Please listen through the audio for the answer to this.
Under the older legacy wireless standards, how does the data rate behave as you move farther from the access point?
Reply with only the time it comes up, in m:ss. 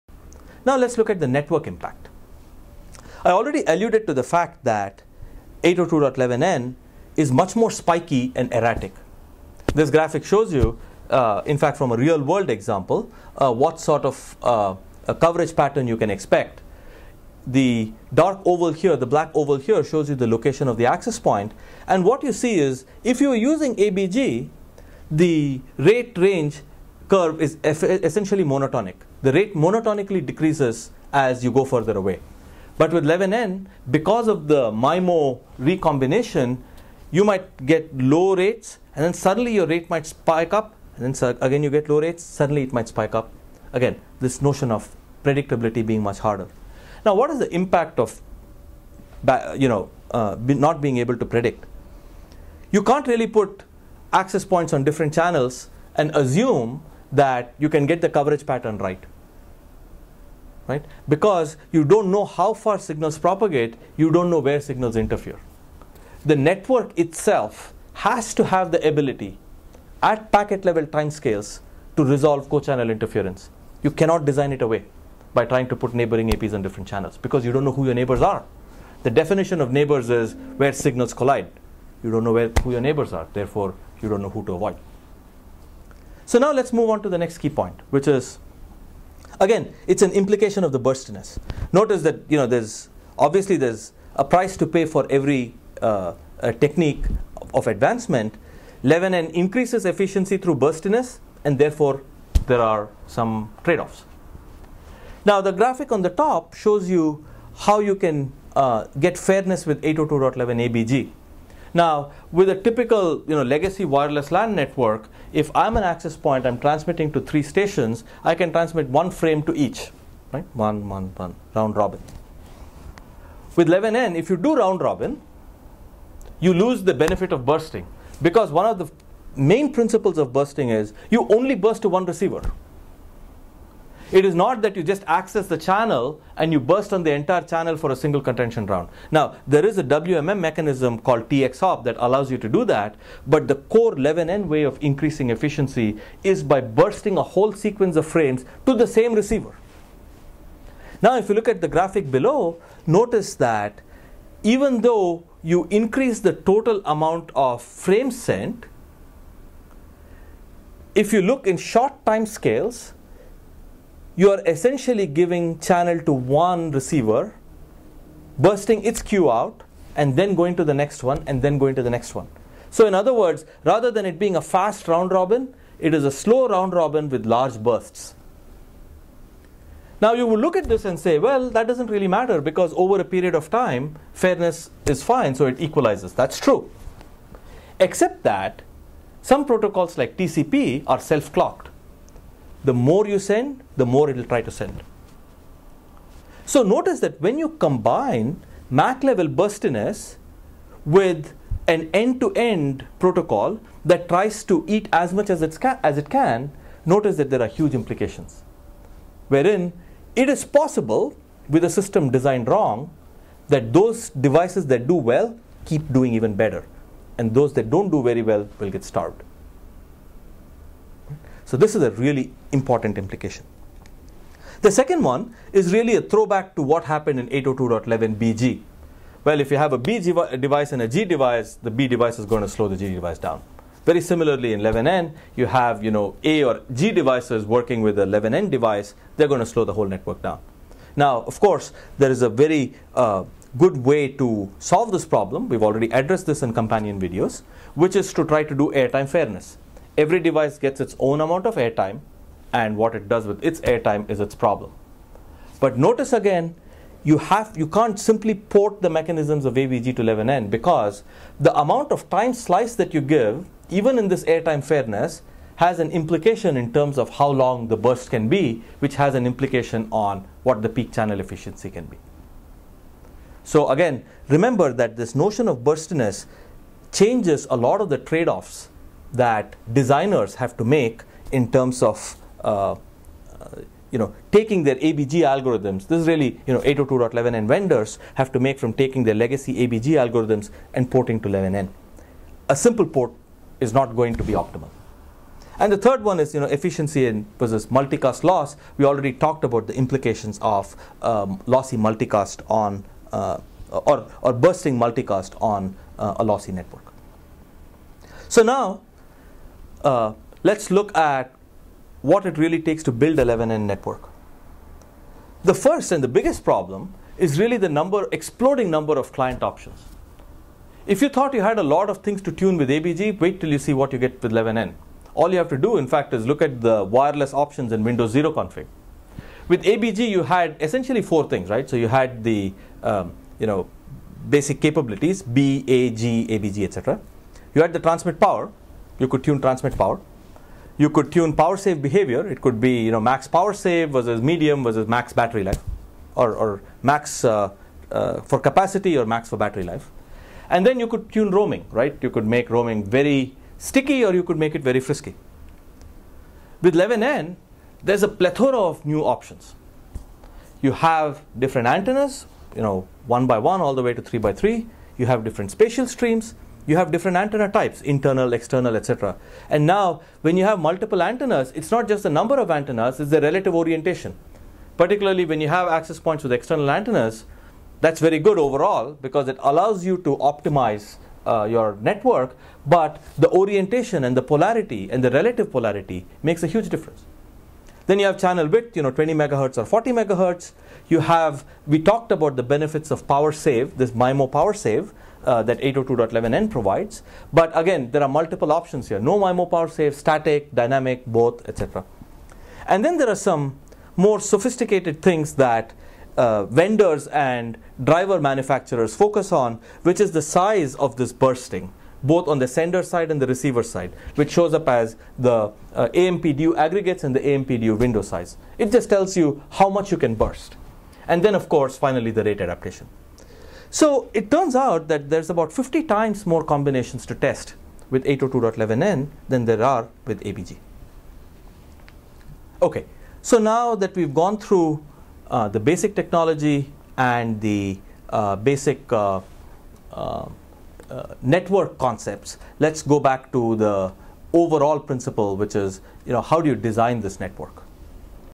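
0:29.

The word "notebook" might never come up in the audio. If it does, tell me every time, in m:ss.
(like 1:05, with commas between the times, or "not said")
not said.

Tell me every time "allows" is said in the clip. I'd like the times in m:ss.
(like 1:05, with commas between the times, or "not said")
2:21, 6:19.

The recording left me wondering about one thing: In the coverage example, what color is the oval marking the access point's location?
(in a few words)
Black.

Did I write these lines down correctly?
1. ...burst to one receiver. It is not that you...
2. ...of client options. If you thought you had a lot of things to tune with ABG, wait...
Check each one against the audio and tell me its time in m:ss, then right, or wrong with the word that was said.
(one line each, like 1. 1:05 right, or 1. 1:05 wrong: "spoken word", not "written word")
1. 2:11 right
2. 5:18 right.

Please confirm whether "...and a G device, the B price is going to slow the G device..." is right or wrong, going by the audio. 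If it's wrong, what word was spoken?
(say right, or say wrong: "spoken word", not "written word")
wrong: "device", not "price".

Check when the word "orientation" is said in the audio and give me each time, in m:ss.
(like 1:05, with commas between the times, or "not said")
6:13, 6:23.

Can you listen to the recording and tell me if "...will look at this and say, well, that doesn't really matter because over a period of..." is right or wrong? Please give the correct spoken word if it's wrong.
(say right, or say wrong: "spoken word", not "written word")
right.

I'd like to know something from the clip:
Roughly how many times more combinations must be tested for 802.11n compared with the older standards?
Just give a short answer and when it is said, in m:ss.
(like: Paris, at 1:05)
50, at 7:05.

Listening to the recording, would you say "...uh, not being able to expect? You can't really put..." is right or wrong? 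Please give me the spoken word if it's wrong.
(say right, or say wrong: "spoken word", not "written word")
wrong: "predict", not "expect".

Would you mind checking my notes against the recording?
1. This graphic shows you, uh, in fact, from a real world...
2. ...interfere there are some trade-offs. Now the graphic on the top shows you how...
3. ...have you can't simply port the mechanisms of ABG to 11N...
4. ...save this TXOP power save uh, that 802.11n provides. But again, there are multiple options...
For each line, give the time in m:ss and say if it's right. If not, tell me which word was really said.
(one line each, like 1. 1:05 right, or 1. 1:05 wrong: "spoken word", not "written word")
1. 0:09 right
2. 1:41 wrong: "therefore", not "interfere"
3. 4:17 right
4. 6:33 wrong: "MIMO", not "TXOP".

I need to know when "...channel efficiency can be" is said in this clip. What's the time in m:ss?
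4:30.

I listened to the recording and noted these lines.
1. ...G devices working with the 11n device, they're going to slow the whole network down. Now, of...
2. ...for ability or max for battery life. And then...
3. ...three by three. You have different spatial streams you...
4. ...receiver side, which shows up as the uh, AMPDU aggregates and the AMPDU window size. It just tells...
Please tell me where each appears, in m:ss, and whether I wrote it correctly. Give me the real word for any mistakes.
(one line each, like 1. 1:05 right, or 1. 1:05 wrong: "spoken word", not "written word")
1. 3:56 right
2. 5:48 wrong: "capacity", not "ability"
3. 6:04 right
4. 6:53 right.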